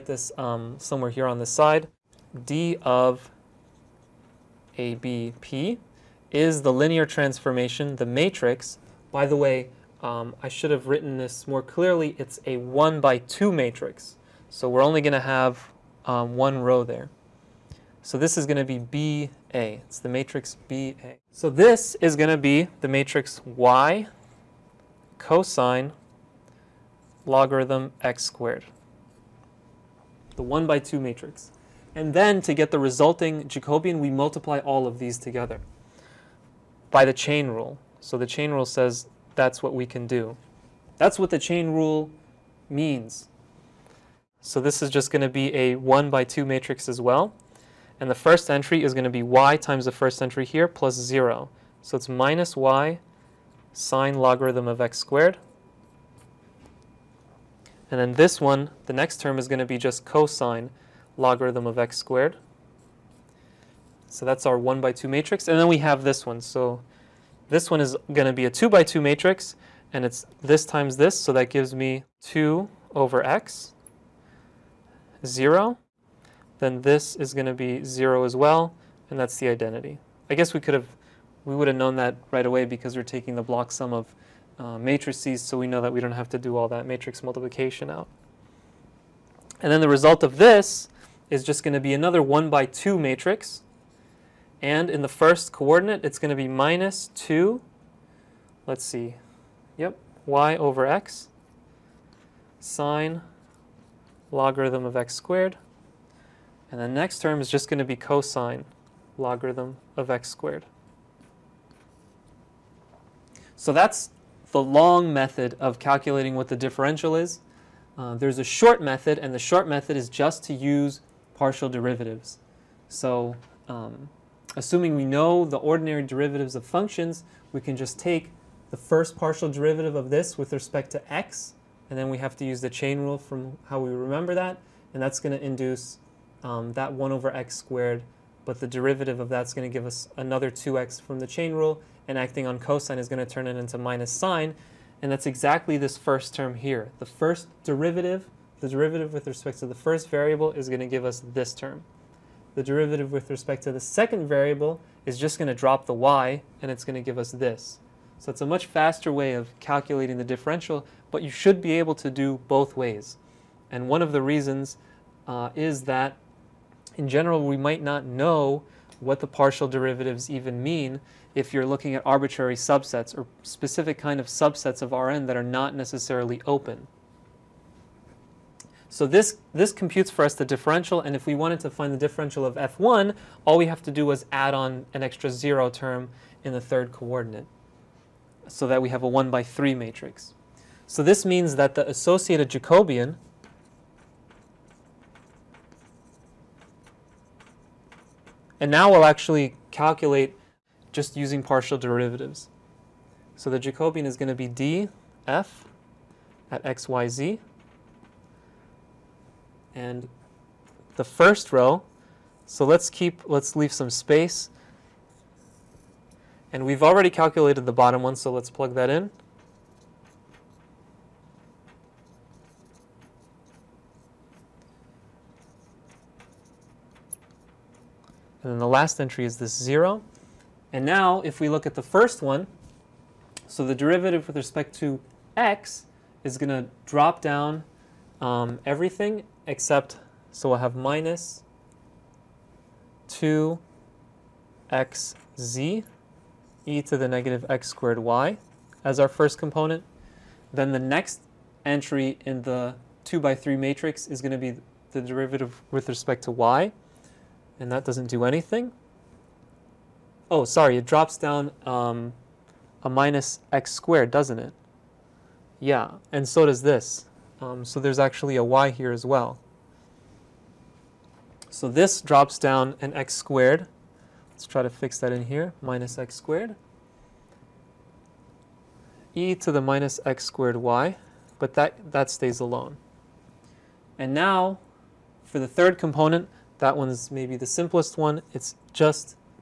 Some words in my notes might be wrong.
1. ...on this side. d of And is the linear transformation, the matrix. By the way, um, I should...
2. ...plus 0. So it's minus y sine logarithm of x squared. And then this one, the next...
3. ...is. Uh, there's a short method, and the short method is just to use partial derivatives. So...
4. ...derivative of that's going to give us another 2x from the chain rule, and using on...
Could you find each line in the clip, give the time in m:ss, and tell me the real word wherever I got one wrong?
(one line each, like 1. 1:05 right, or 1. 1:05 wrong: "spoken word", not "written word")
1. 0:01 wrong: "ABP", not "And"
2. 0:50 right
3. 1:57 right
4. 2:18 wrong: "acting", not "using".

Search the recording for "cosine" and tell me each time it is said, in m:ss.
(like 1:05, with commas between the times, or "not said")
0:25, 1:00, 1:47, 2:22.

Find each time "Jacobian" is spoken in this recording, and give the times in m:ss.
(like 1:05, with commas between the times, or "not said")
0:33, 3:12, 3:23.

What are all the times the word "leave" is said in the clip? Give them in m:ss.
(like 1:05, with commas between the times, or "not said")
3:33.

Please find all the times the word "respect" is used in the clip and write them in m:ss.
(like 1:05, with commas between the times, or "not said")
2:10, 2:29, 2:33, 3:54, 4:15.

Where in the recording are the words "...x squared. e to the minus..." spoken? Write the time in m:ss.
4:35.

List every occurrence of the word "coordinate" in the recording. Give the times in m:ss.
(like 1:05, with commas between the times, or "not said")
1:35, 3:06.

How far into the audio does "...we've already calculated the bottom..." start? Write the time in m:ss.
3:36.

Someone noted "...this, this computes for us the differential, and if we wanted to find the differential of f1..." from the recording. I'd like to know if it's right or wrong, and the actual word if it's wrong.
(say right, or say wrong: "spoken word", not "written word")
right.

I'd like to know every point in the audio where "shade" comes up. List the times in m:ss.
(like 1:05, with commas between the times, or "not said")
not said.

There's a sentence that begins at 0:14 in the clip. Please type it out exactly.
So we're only going to have um, one row there.